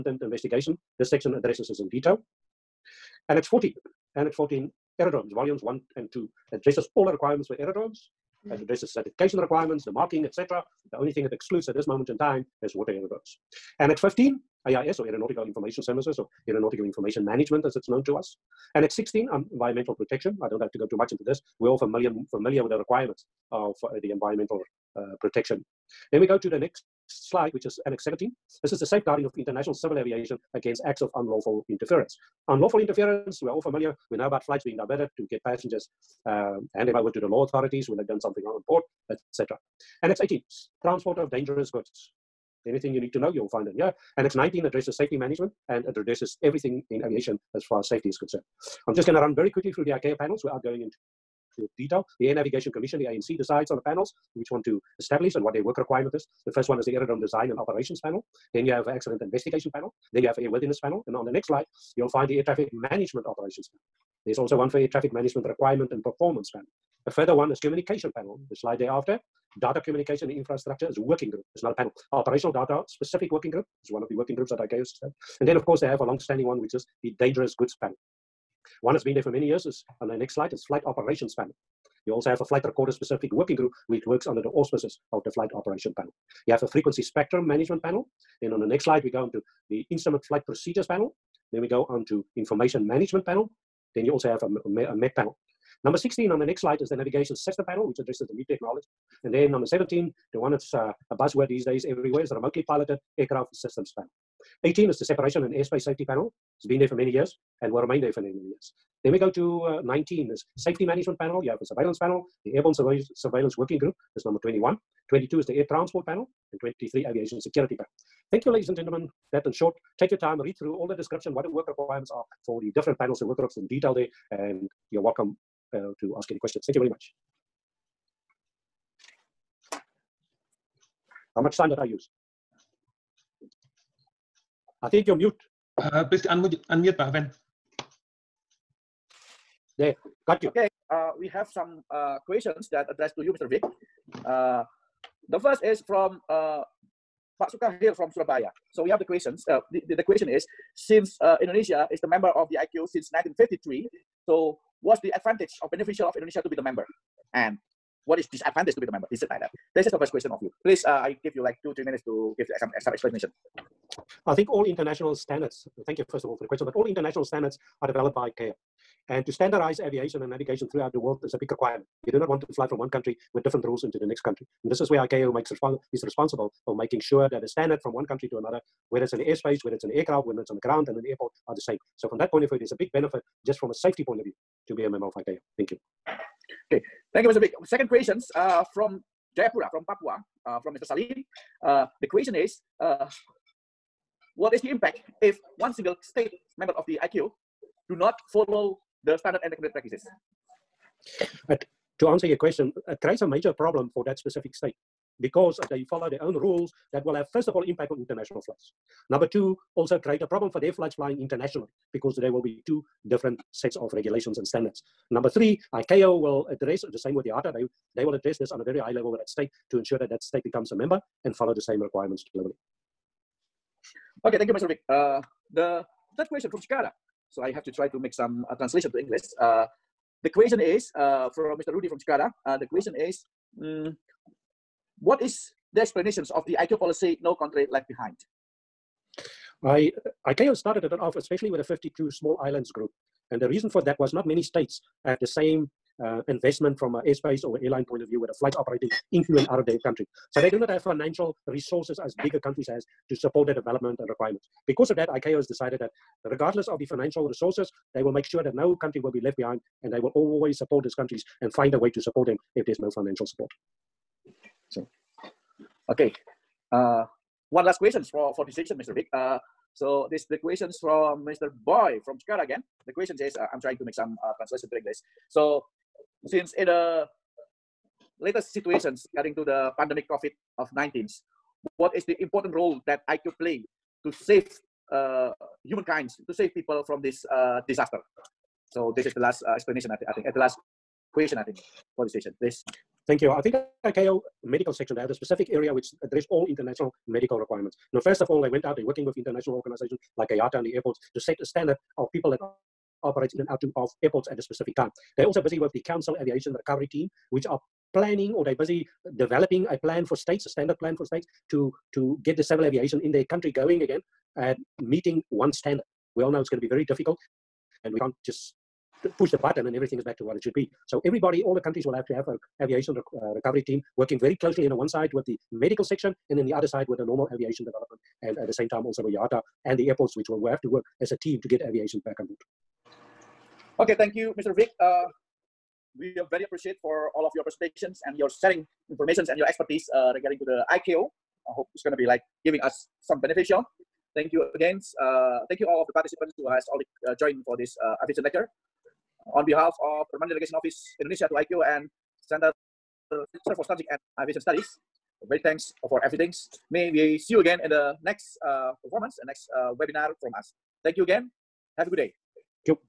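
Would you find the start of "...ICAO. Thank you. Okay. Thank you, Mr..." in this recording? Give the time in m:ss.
3:05.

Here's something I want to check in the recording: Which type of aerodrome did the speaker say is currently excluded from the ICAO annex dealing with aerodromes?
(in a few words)
Water aerodromes.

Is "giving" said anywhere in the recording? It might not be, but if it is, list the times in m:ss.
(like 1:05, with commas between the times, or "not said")
5:42.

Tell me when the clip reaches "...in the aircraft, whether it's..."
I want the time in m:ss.
2:59.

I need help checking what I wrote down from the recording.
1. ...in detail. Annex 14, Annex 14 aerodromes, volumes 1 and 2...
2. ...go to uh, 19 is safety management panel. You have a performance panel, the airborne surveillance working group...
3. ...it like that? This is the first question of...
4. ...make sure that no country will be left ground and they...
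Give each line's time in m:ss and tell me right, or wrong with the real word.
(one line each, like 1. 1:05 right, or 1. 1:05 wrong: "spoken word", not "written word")
1. 0:01 right
2. 1:49 wrong: "surveillance", not "performance"
3. 2:39 right
4. 4:18 wrong: "behind", not "ground".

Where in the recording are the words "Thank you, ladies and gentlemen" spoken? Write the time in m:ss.
1:58.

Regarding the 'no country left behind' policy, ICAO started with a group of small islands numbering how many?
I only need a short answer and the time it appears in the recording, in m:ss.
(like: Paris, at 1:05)
52, at 4:01.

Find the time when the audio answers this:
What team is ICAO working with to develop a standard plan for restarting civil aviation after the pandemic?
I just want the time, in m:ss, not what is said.
5:05.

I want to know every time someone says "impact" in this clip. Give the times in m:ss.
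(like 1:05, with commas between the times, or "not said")
3:14, 3:27.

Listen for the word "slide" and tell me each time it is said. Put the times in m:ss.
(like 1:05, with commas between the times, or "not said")
0:27, 1:01, 1:08, 1:20, 1:28, 1:36.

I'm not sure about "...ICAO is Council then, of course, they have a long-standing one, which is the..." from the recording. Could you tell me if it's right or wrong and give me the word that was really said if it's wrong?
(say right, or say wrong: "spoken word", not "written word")
wrong: "And", not "Council".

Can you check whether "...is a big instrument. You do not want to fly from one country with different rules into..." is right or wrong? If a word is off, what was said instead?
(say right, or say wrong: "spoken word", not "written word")
wrong: "requirement", not "instrument".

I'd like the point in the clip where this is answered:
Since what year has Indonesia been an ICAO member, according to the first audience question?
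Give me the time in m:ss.
2:33.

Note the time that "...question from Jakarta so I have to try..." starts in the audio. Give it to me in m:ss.
3:46.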